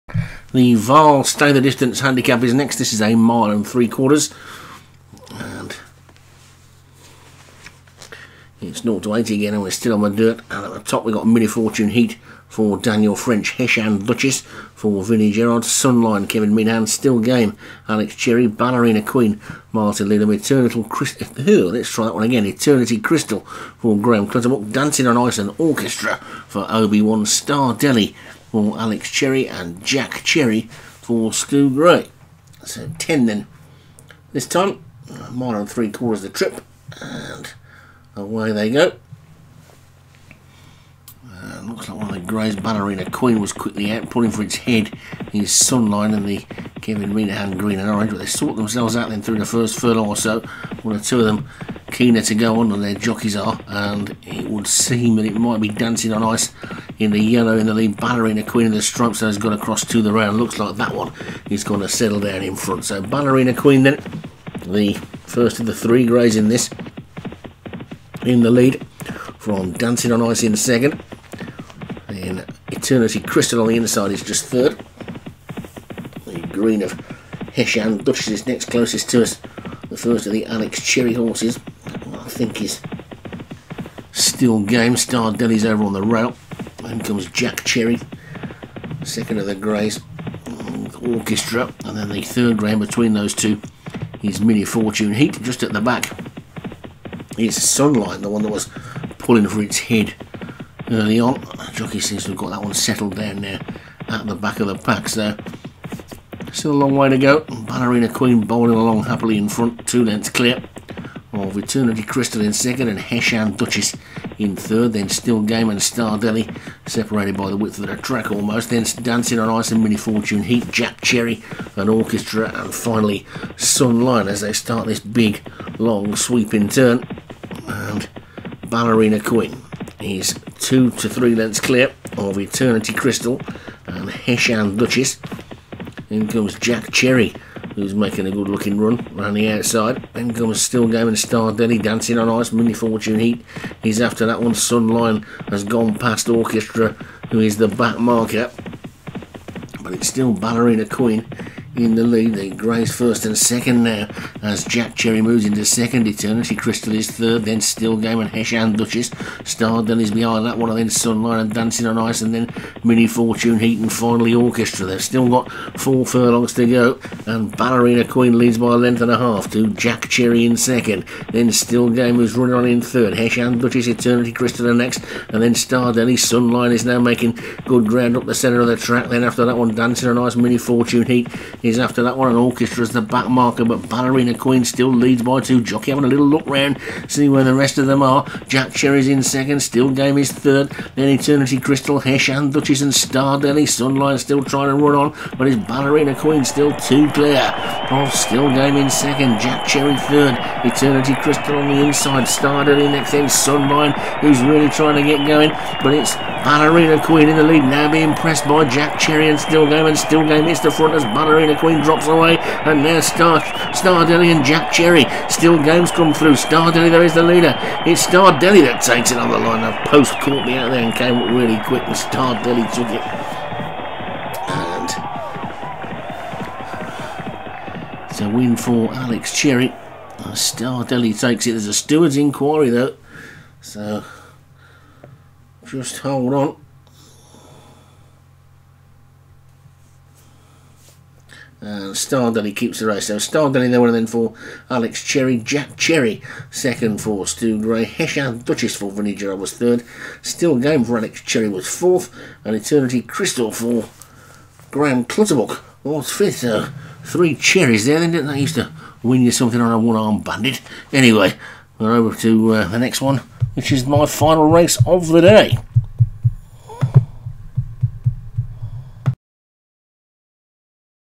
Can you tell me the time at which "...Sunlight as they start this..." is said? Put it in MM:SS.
02:03.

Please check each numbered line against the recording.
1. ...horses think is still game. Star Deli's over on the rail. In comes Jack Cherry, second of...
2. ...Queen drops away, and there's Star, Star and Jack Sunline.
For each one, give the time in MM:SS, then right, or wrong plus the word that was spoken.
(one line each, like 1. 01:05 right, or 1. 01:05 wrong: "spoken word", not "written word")
1. 01:21 right
2. 03:31 wrong: "Cherry", not "Sunline".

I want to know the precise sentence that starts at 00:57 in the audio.
Ballerina Queen of the Stripes that has gone across to the round.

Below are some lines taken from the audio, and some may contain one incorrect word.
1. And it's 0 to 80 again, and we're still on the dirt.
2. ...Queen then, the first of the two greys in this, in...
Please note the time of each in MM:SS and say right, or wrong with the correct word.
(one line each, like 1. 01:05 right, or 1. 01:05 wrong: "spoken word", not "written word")
1. 00:05 right
2. 01:03 wrong: "three", not "two".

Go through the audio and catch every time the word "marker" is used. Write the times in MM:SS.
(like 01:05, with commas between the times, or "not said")
02:27, 03:03.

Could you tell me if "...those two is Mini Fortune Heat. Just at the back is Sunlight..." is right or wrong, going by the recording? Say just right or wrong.
right.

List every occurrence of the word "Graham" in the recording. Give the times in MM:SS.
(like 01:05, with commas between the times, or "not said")
00:23, 04:14.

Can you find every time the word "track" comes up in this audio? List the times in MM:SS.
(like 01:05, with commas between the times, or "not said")
01:57, 02:58.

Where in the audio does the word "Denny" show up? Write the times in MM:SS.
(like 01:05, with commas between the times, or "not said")
02:21, 02:55.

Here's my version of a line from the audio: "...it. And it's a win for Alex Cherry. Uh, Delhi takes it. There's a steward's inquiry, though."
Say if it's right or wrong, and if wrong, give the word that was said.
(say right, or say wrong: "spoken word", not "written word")
wrong: "Star", not "Delhi".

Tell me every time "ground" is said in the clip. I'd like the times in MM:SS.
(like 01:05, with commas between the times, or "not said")
02:57.